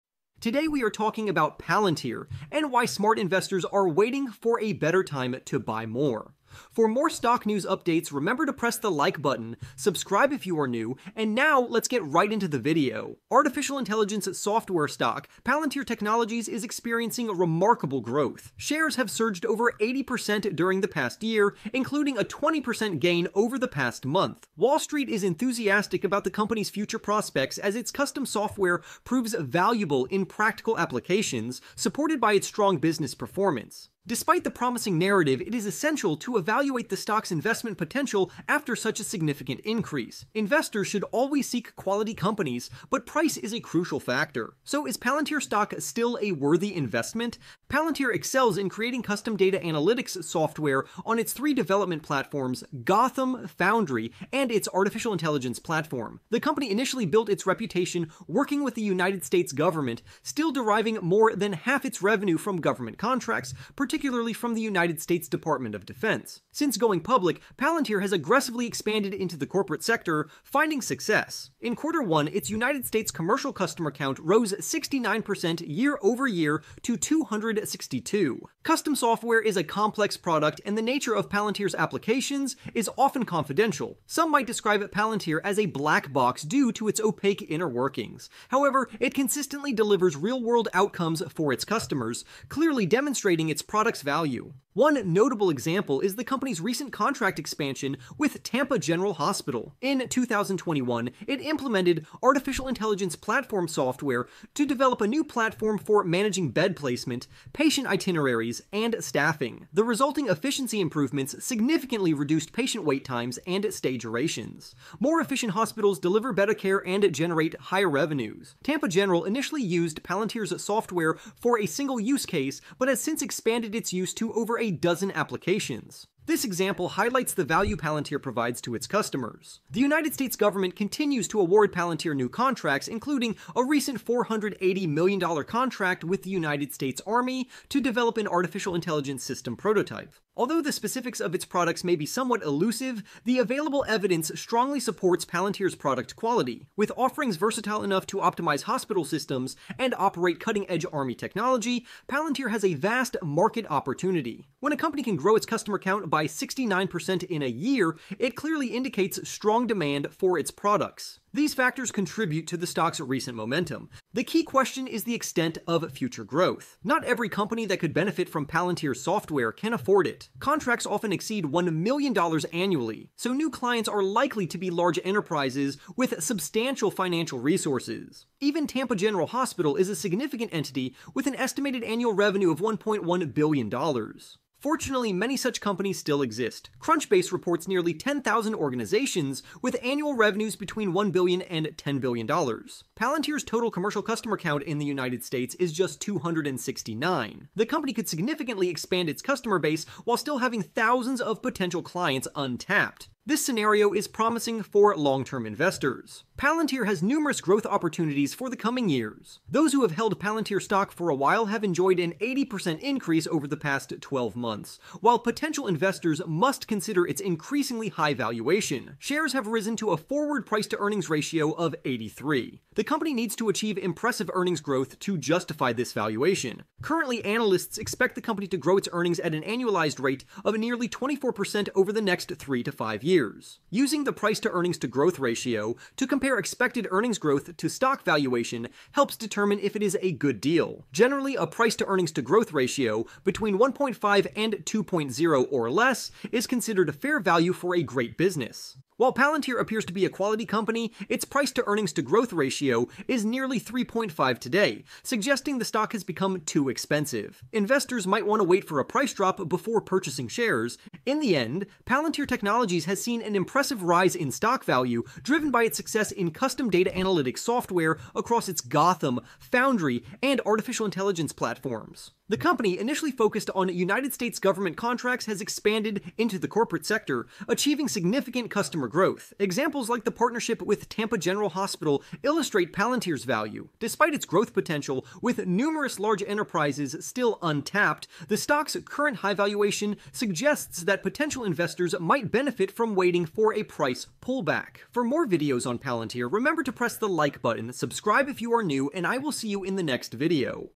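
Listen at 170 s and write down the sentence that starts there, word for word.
Contracts often exceed $1 million annually, so new clients are likely to be large enterprises with substantial financial resources.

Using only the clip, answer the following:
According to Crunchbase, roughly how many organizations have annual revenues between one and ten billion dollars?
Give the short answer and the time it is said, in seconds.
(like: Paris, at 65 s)
10,000, at 187 s.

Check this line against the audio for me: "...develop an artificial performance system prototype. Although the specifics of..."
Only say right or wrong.
wrong.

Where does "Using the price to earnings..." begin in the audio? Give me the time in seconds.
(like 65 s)
233 s.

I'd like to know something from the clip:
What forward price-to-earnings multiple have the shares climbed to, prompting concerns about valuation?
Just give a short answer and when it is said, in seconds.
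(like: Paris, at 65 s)
83, at 221 s.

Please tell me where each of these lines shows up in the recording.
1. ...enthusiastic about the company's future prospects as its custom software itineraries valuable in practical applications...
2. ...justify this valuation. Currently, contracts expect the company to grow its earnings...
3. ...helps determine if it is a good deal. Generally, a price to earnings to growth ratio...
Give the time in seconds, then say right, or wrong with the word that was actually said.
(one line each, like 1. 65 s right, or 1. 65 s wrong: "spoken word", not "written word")
1. 25 s wrong: "proves", not "itineraries"
2. 225 s wrong: "analysts", not "contracts"
3. 238 s right.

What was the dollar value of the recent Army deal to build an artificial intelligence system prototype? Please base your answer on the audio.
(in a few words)
$480 million.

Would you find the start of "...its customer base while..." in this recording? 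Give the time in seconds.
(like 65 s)
199 s.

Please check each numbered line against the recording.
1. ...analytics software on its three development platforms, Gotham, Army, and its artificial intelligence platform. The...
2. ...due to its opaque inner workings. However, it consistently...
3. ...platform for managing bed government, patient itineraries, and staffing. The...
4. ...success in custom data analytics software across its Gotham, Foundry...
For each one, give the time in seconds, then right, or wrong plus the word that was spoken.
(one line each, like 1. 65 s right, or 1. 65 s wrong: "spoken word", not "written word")
1. 49 s wrong: "Foundry", not "Army"
2. 86 s right
3. 105 s wrong: "placement", not "government"
4. 265 s right.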